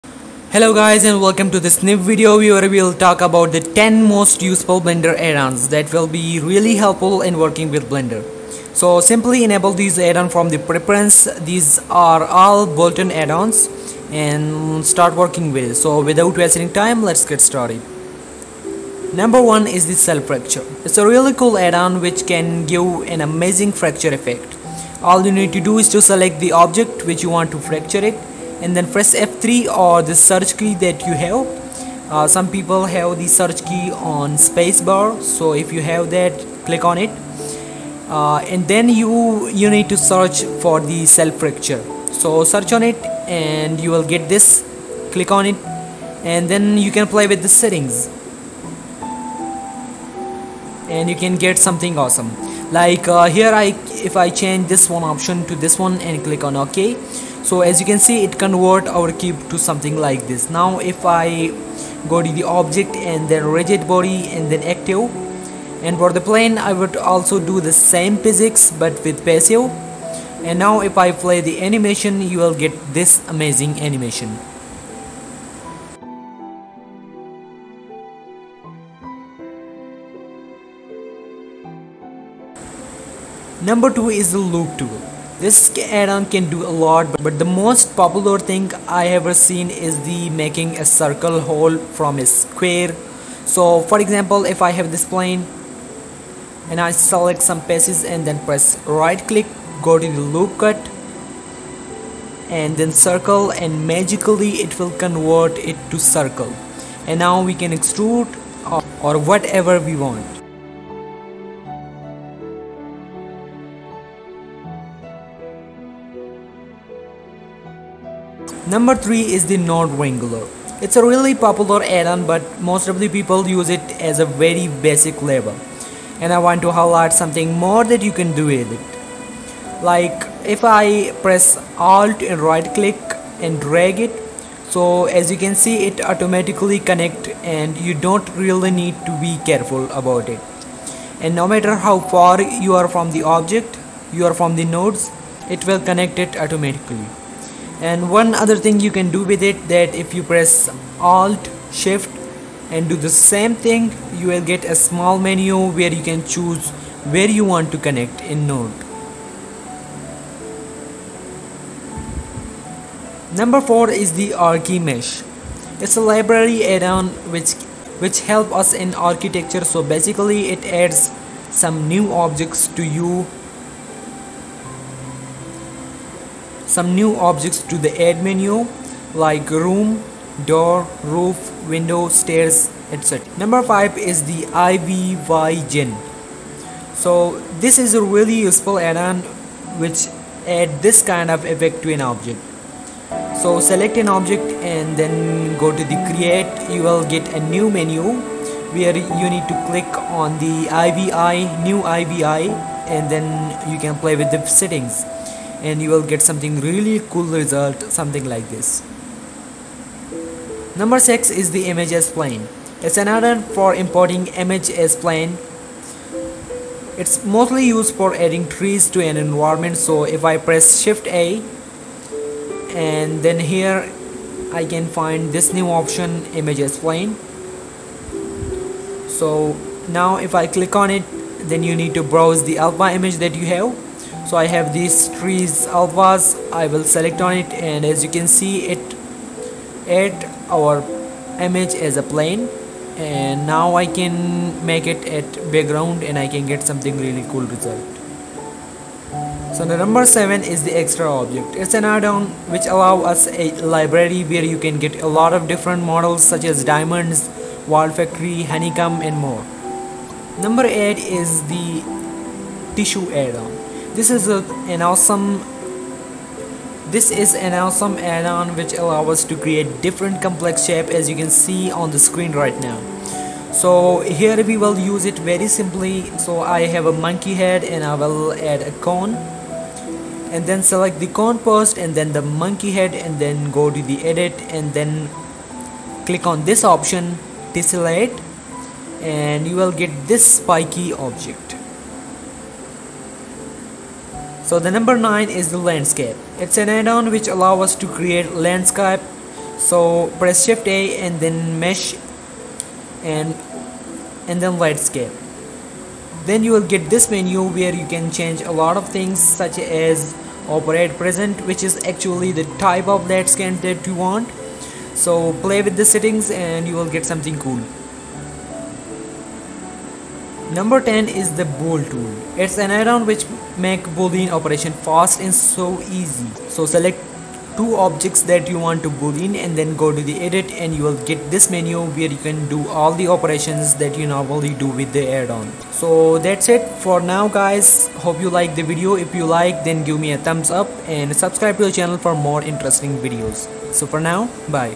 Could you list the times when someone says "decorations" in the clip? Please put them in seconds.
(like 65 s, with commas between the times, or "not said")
not said.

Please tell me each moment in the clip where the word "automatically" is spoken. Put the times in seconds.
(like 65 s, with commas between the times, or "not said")
135 s, 146 s.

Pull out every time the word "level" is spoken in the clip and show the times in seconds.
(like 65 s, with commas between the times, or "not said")
125 s.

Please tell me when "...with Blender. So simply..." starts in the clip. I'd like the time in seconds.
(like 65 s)
7 s.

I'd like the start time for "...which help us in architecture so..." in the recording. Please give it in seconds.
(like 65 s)
168 s.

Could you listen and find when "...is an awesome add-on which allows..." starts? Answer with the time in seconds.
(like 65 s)
267 s.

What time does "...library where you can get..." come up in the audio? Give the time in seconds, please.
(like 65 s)
253 s.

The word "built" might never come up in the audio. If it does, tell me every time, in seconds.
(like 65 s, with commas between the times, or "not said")
12 s.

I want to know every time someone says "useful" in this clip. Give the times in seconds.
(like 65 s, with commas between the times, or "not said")
4 s, 188 s.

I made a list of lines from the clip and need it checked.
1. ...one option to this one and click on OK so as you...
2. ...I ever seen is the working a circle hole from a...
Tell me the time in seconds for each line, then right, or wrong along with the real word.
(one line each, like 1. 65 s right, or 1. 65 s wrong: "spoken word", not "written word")
1. 54 s right
2. 88 s wrong: "making", not "working".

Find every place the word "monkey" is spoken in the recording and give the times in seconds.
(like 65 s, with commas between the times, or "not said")
276 s, 282 s.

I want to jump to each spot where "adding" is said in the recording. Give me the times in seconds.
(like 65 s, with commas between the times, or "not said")
218 s.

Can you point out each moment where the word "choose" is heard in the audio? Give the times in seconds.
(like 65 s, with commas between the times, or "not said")
156 s.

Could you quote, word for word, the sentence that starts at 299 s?
So press shift A and then mesh and and then landscape.